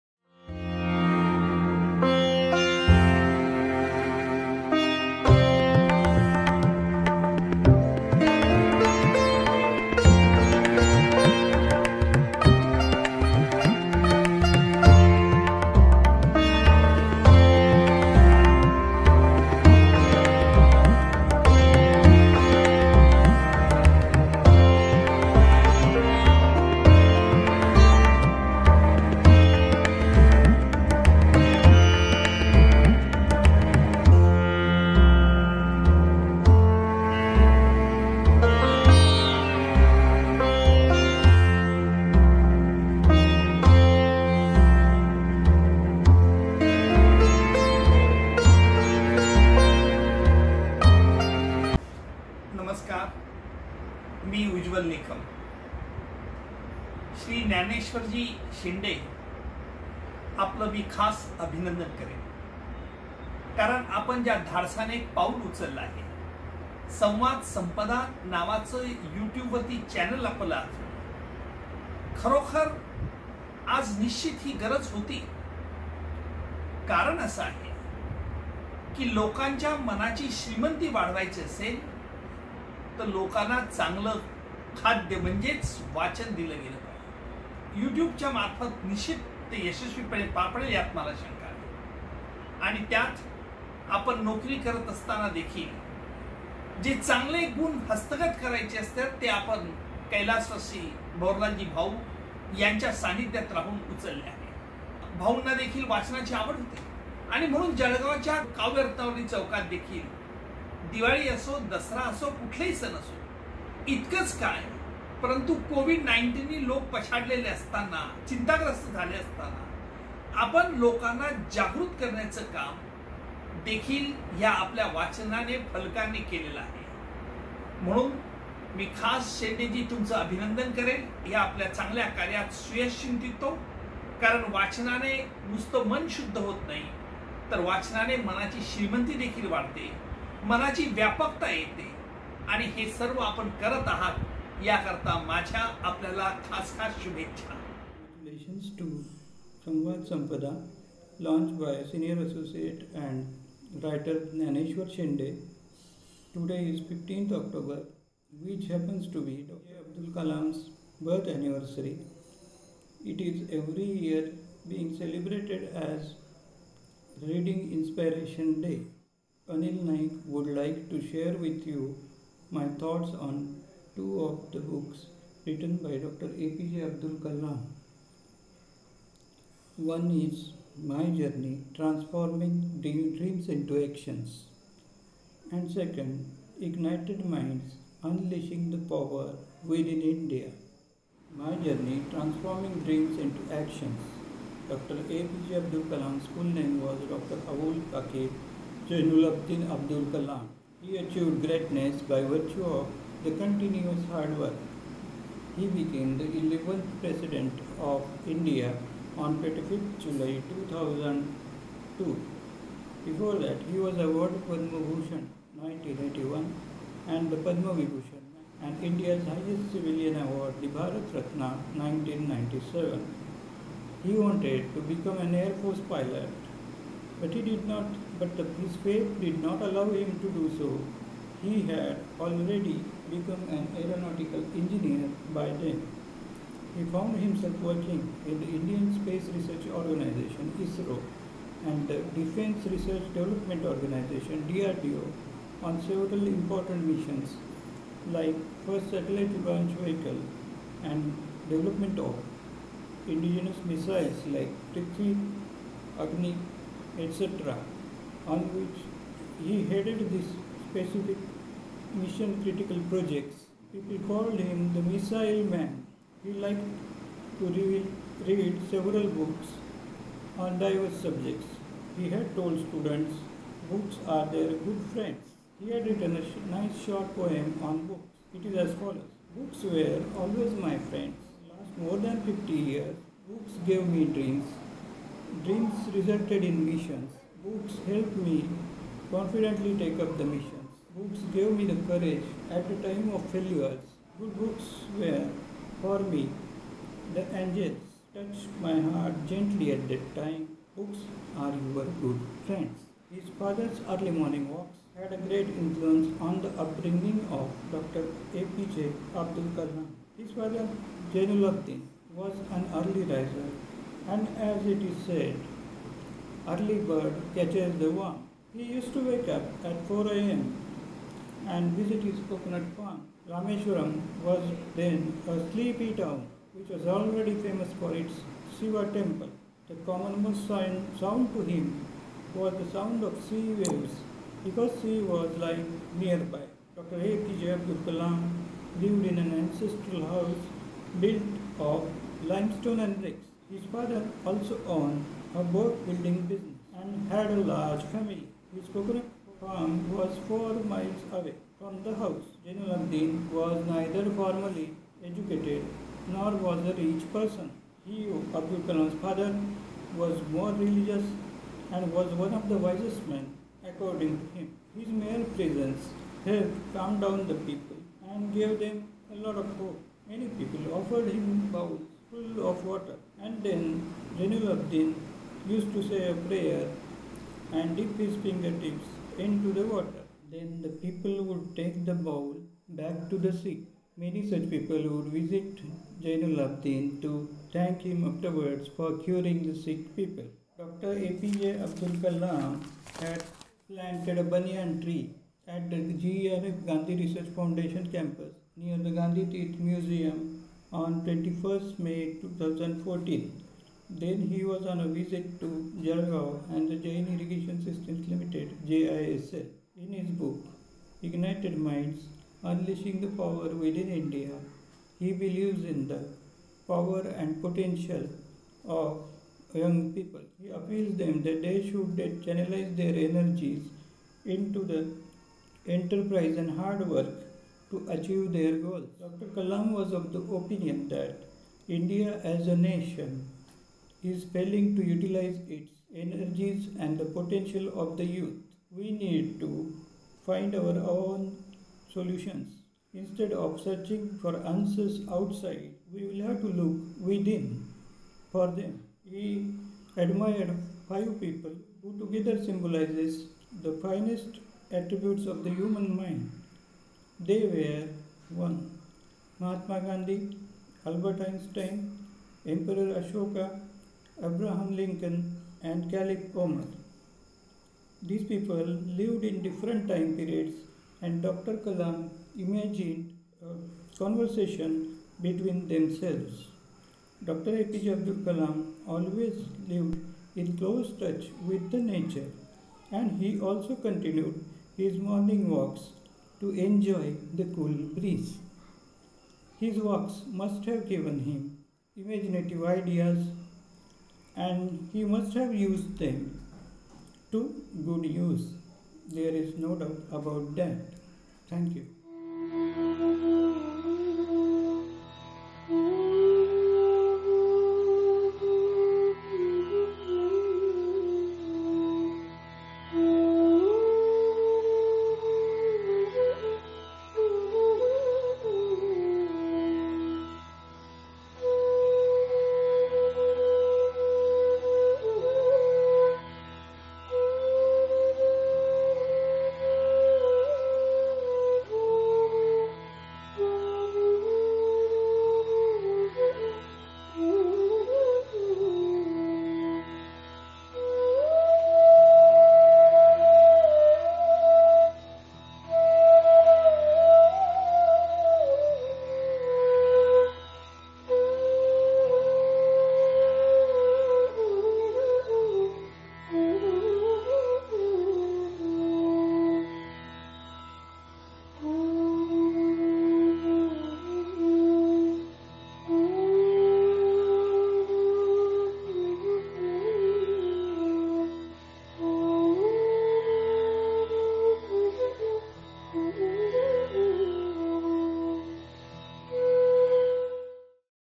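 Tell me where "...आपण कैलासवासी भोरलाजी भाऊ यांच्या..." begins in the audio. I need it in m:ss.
1:39.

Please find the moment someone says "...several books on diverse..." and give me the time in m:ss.
4:28.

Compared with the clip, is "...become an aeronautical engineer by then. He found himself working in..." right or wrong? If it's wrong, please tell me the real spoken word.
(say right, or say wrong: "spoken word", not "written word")
right.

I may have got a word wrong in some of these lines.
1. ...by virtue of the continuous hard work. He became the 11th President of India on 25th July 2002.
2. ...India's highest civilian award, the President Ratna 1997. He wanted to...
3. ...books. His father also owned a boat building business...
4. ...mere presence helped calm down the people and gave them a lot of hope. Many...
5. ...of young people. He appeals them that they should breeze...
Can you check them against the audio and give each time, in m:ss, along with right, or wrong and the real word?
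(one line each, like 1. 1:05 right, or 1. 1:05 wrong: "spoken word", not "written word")
1. 3:22 right
2. 3:38 wrong: "Bharat", not "President"
3. 5:42 wrong: "bricks", not "books"
4. 6:04 right
5. 6:58 wrong: "channelize", not "breeze".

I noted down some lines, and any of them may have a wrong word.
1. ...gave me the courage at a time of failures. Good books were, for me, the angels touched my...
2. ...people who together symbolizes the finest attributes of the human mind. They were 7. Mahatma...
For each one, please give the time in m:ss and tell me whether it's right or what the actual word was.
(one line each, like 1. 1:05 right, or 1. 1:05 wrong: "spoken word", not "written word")
1. 4:51 right
2. 7:31 wrong: "1", not "7".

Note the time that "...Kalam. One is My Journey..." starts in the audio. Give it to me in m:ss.
2:57.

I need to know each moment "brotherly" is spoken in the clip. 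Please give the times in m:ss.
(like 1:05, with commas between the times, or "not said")
not said.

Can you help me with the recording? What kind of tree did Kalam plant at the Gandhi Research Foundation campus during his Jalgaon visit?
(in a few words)
banyan tree.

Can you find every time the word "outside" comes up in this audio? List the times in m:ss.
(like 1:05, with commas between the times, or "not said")
7:25.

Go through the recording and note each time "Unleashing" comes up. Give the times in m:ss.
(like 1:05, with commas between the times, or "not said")
3:08, 6:52.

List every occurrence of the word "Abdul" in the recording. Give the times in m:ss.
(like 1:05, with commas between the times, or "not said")
2:56, 3:15, 3:19, 5:09, 5:37, 5:58, 6:31, 7:57.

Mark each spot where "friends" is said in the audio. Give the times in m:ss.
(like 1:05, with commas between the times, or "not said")
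4:34, 4:40, 5:02.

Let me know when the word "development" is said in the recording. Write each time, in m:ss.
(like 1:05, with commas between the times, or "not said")
4:03, 4:11.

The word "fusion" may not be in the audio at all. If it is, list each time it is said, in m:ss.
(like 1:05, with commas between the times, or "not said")
not said.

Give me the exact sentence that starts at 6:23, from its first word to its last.
Many such people would visit Jainulabdin to thank him afterwards for curing the sick people.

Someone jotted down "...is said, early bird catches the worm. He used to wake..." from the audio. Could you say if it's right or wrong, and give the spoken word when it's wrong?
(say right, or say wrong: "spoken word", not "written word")
right.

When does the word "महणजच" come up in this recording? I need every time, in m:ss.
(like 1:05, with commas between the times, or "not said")
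1:25.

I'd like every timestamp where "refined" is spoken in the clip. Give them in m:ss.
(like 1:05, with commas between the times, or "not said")
not said.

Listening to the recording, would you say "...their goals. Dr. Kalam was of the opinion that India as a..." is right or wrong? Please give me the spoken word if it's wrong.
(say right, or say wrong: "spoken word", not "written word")
right.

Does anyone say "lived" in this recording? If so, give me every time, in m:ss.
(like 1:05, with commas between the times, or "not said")
5:38, 7:48, 7:59.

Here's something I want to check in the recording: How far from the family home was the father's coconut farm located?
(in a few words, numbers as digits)
four miles.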